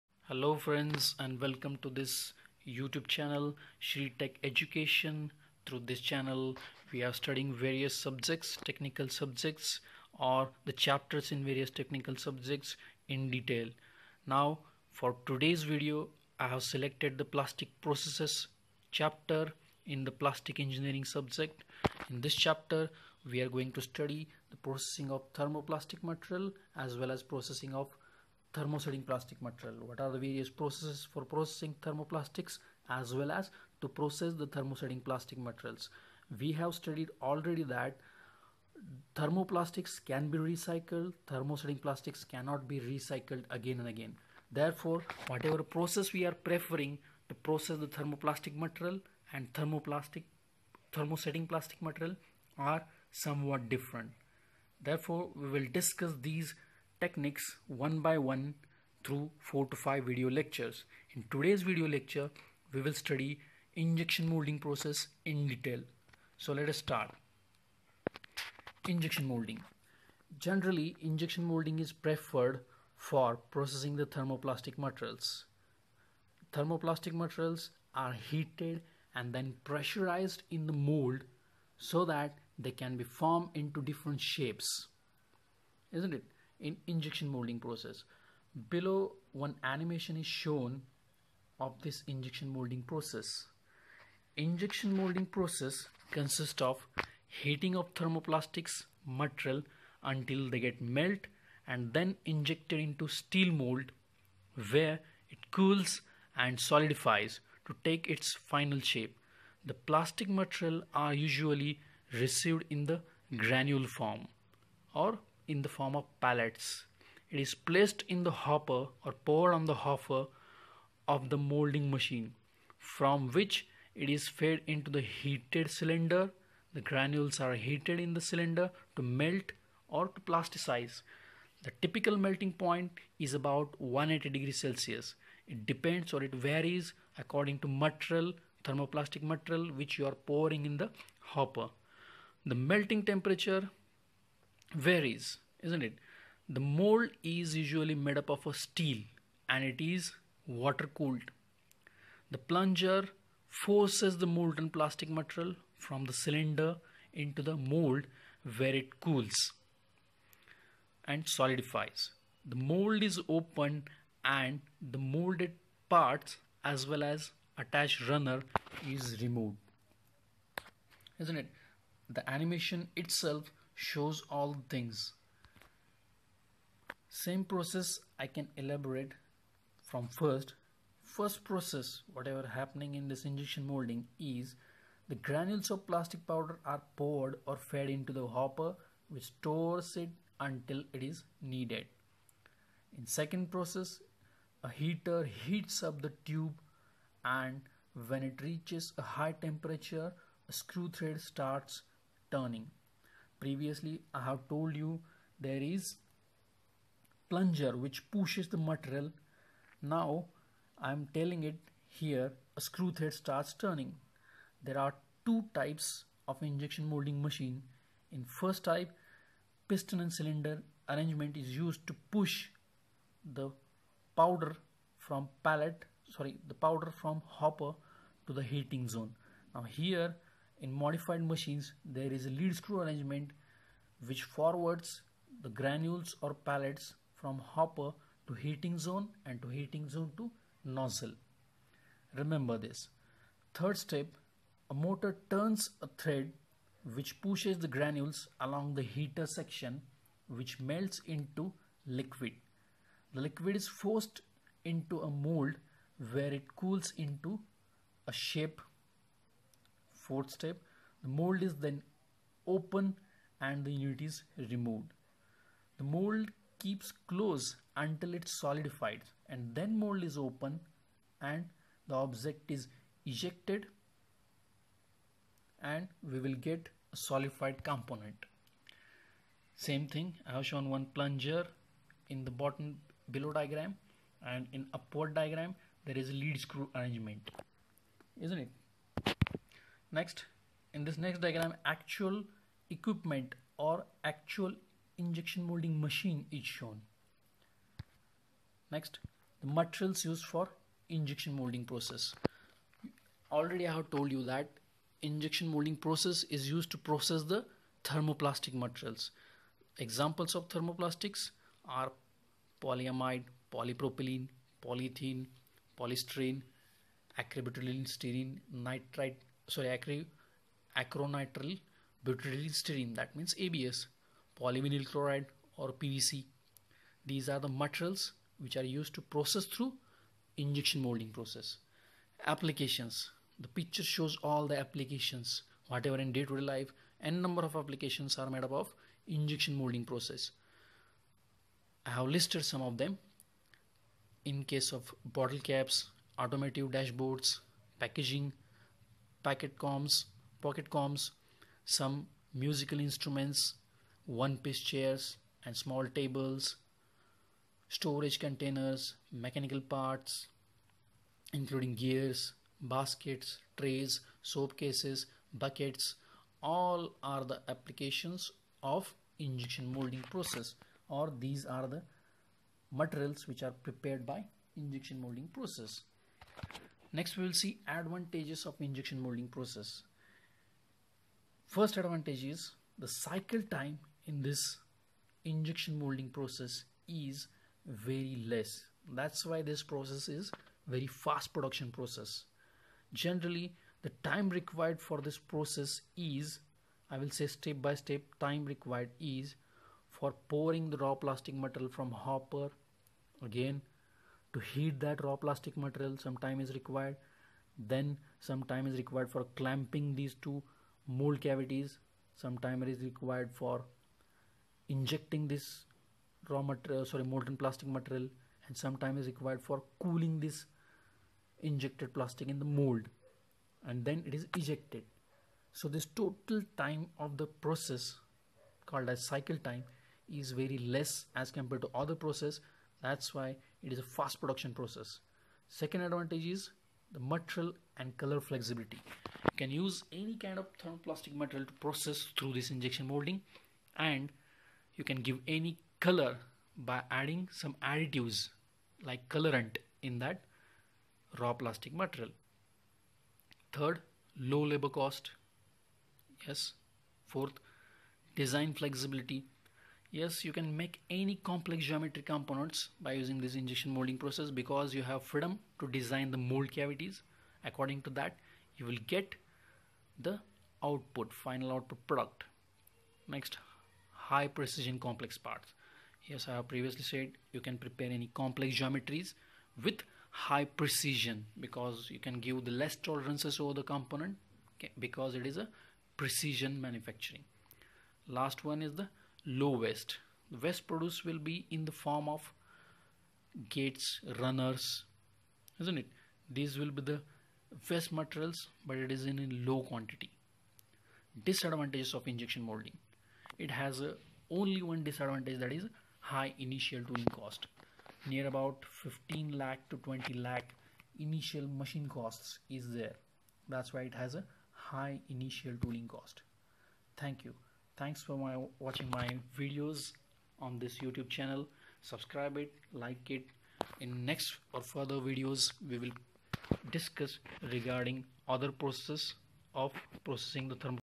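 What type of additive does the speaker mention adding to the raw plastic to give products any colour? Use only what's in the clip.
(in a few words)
colorant.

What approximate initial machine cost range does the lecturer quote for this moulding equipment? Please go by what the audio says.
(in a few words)
15 to 20 lakh.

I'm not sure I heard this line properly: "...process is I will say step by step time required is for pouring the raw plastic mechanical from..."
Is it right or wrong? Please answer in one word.
wrong.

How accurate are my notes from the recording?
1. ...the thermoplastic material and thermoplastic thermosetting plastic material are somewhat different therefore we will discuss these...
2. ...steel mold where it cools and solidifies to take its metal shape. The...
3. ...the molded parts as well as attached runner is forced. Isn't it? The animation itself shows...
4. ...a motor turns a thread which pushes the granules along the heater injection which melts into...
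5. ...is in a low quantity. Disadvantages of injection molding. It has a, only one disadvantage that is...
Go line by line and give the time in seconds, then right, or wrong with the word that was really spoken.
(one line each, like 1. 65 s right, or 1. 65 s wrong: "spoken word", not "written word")
1. 47 s right
2. 103 s wrong: "final", not "metal"
3. 164 s wrong: "removed", not "forced"
4. 244 s wrong: "section", not "injection"
5. 498 s right.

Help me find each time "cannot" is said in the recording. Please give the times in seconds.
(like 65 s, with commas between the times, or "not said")
42 s.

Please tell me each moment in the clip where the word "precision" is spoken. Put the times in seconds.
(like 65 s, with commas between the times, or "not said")
474 s, 480 s, 485 s.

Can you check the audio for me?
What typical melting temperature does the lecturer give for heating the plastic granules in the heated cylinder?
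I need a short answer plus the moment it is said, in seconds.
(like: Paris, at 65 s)
180 degrees Celsius, at 133 s.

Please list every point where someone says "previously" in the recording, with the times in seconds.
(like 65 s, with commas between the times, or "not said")
203 s, 476 s.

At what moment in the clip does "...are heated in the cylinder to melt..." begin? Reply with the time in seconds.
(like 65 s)
127 s.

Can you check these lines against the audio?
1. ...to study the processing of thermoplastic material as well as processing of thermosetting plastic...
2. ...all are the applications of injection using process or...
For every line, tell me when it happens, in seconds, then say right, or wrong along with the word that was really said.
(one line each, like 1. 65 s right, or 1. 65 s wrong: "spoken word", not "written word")
1. 23 s right
2. 366 s wrong: "molding", not "using".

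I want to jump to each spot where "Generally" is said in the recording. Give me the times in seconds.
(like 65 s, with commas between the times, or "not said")
70 s, 392 s.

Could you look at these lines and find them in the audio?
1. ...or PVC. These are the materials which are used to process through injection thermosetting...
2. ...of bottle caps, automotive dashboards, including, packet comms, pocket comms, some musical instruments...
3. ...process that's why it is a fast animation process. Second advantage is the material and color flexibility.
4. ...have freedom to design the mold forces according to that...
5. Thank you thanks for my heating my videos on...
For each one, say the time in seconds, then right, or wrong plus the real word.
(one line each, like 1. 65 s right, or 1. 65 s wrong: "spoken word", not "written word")
1. 325 s wrong: "molding", not "thermosetting"
2. 344 s wrong: "packaging", not "including"
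3. 431 s wrong: "production", not "animation"
4. 464 s wrong: "cavities", not "forces"
5. 516 s wrong: "watching", not "heating".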